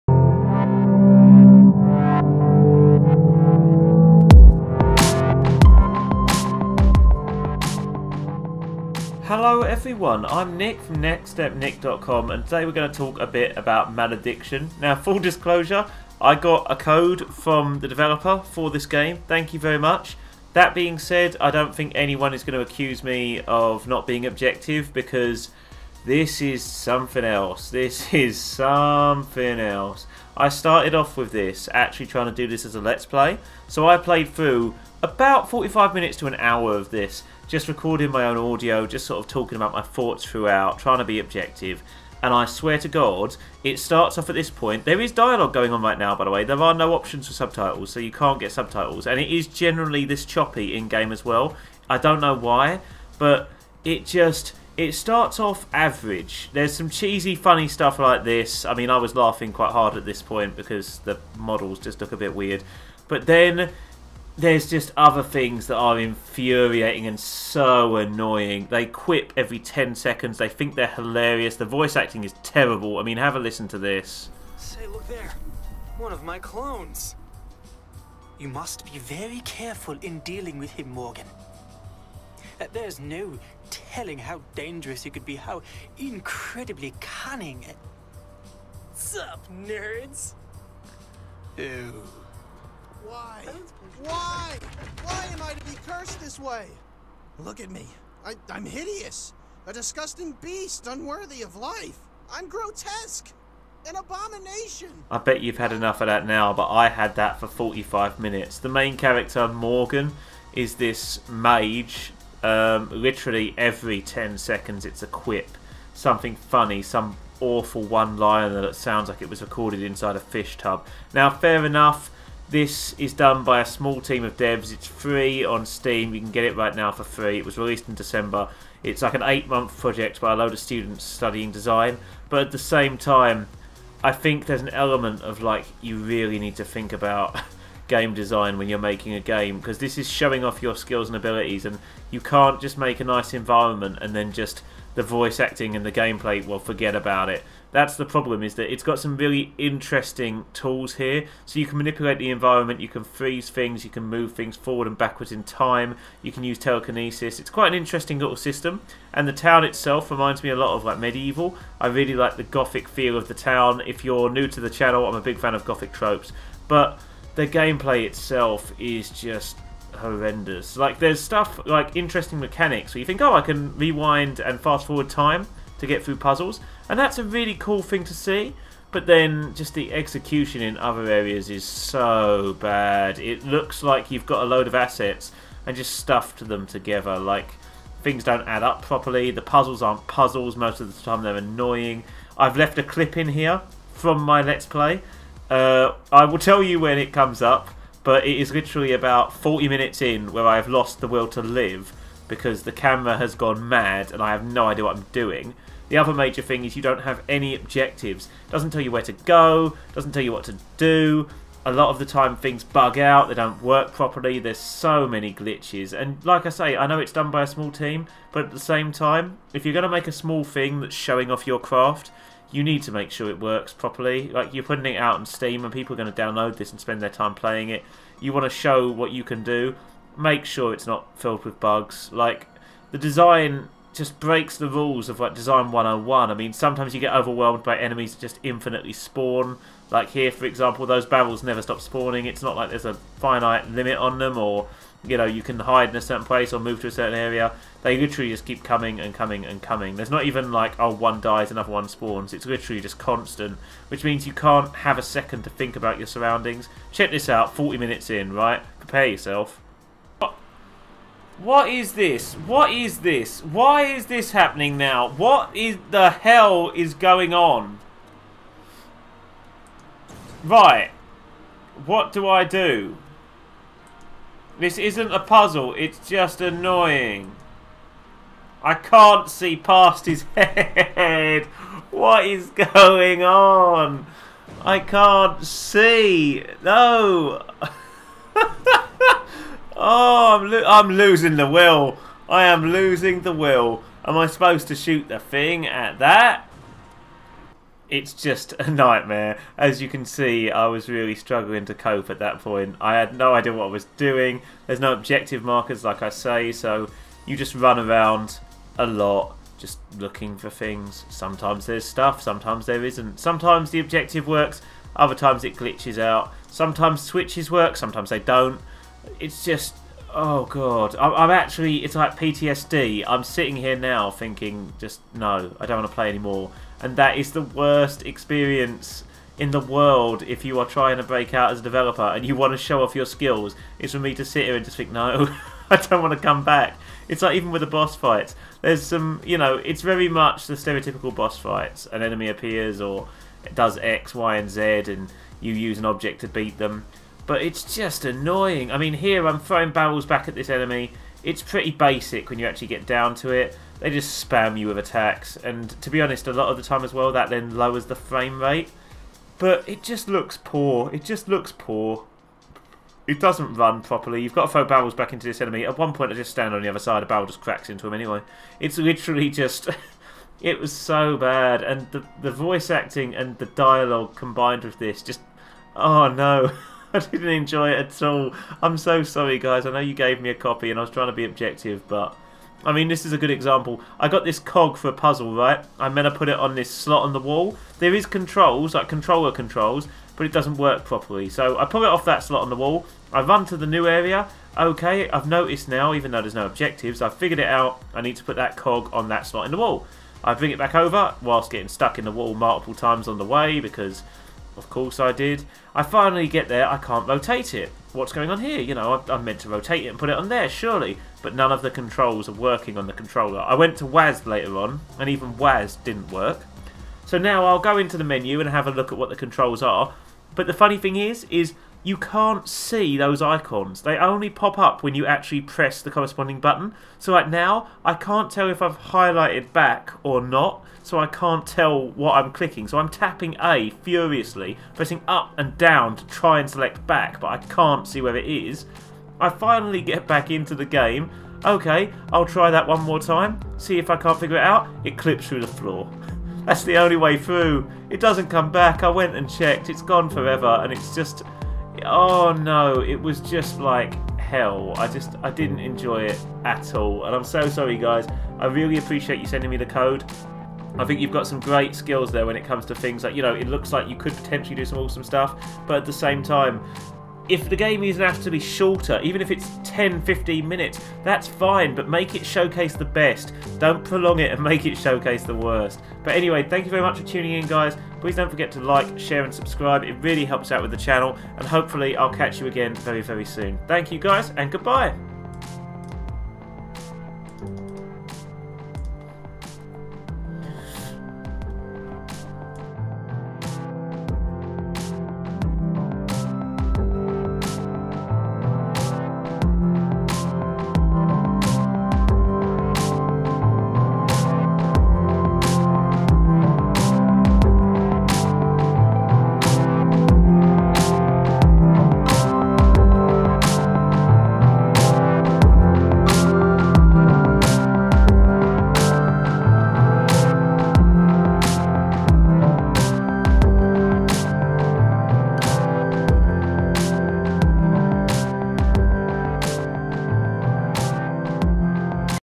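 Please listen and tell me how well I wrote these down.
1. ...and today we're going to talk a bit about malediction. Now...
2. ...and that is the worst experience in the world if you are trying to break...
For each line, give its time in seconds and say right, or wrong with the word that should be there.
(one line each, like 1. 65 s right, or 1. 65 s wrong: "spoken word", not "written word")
1. 12 s right
2. 326 s right.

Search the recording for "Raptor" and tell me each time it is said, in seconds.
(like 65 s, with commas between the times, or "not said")
not said.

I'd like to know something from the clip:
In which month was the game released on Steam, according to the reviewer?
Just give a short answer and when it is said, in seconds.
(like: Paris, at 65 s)
December, at 127 s.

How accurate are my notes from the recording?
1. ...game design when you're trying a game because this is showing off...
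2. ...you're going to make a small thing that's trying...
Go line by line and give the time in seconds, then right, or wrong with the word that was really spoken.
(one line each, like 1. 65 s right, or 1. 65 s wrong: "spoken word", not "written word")
1. 137 s wrong: "making", not "trying"
2. 219 s wrong: "showing", not "trying".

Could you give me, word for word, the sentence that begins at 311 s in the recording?
Sometimes there's stuff, sometimes there isn't.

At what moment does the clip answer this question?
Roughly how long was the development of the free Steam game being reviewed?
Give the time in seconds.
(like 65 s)
129 s.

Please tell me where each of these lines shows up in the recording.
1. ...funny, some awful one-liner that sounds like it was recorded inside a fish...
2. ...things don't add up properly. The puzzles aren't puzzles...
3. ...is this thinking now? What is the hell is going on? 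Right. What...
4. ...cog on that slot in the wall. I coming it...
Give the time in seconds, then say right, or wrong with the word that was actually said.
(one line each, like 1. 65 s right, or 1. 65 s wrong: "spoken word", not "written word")
1. 116 s right
2. 188 s right
3. 263 s wrong: "happening", not "thinking"
4. 398 s wrong: "bring", not "coming".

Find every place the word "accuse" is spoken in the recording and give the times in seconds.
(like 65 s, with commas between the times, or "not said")
22 s.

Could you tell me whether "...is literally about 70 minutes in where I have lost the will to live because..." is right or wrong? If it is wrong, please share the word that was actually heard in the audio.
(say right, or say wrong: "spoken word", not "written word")
wrong: "40", not "70".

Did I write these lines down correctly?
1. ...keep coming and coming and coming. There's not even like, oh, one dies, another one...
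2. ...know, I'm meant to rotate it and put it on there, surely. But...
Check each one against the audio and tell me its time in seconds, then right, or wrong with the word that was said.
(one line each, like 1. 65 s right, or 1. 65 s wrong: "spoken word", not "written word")
1. 248 s right
2. 408 s right.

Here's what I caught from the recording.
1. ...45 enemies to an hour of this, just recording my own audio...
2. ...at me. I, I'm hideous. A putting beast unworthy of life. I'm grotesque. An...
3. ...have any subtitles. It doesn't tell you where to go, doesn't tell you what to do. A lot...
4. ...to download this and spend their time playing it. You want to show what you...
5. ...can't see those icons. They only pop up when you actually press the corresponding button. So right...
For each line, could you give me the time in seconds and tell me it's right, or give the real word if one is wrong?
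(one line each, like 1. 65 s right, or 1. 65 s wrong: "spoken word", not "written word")
1. 35 s wrong: "minutes", not "enemies"
2. 97 s wrong: "disgusting", not "putting"
3. 207 s wrong: "objectives", not "subtitles"
4. 226 s right
5. 421 s right.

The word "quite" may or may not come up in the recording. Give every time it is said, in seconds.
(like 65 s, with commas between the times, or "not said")
59 s, 157 s.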